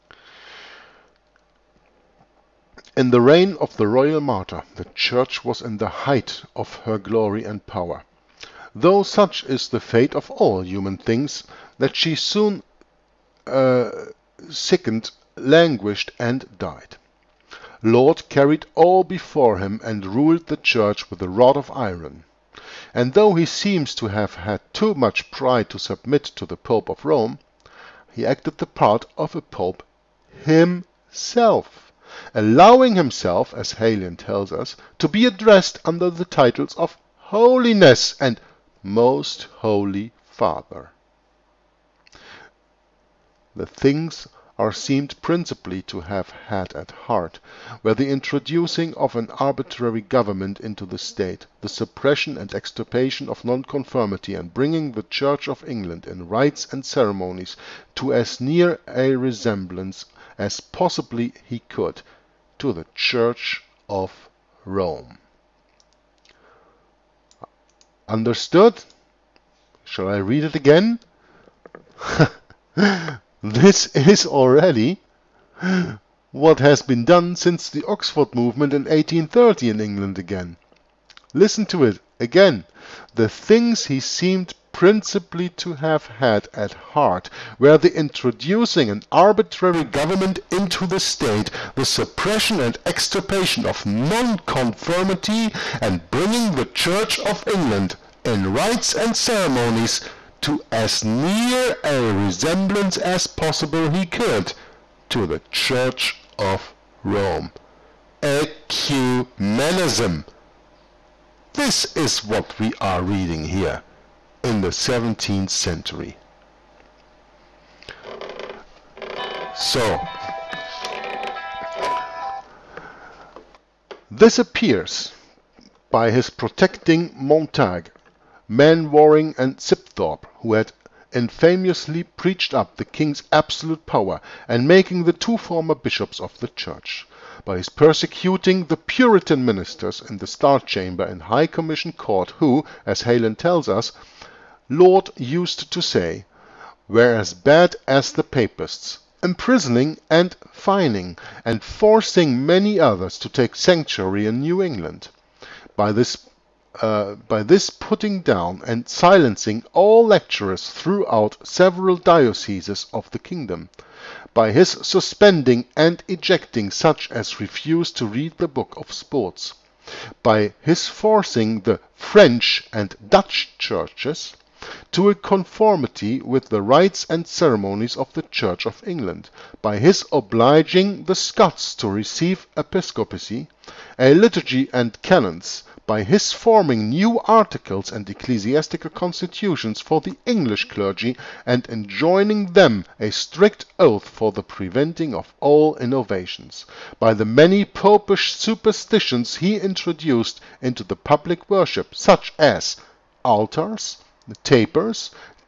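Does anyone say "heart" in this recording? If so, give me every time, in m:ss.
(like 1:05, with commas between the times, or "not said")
0:46, 1:26.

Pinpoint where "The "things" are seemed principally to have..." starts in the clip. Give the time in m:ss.
0:43.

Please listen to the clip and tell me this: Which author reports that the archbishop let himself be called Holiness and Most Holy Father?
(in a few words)
Galen.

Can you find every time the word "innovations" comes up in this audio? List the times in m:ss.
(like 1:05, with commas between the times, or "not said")
3:15.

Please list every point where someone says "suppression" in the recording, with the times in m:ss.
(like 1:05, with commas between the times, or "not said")
0:51, 1:31.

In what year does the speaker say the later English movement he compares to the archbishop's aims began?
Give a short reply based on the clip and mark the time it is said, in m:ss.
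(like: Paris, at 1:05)
1830, at 1:18.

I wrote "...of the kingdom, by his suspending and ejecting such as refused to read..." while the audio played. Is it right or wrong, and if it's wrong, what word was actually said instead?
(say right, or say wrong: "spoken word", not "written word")
right.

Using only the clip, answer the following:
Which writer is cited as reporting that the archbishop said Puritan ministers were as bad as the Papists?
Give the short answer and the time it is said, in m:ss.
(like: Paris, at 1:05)
Heylin, at 2:23.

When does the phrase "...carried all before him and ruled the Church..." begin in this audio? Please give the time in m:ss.
0:18.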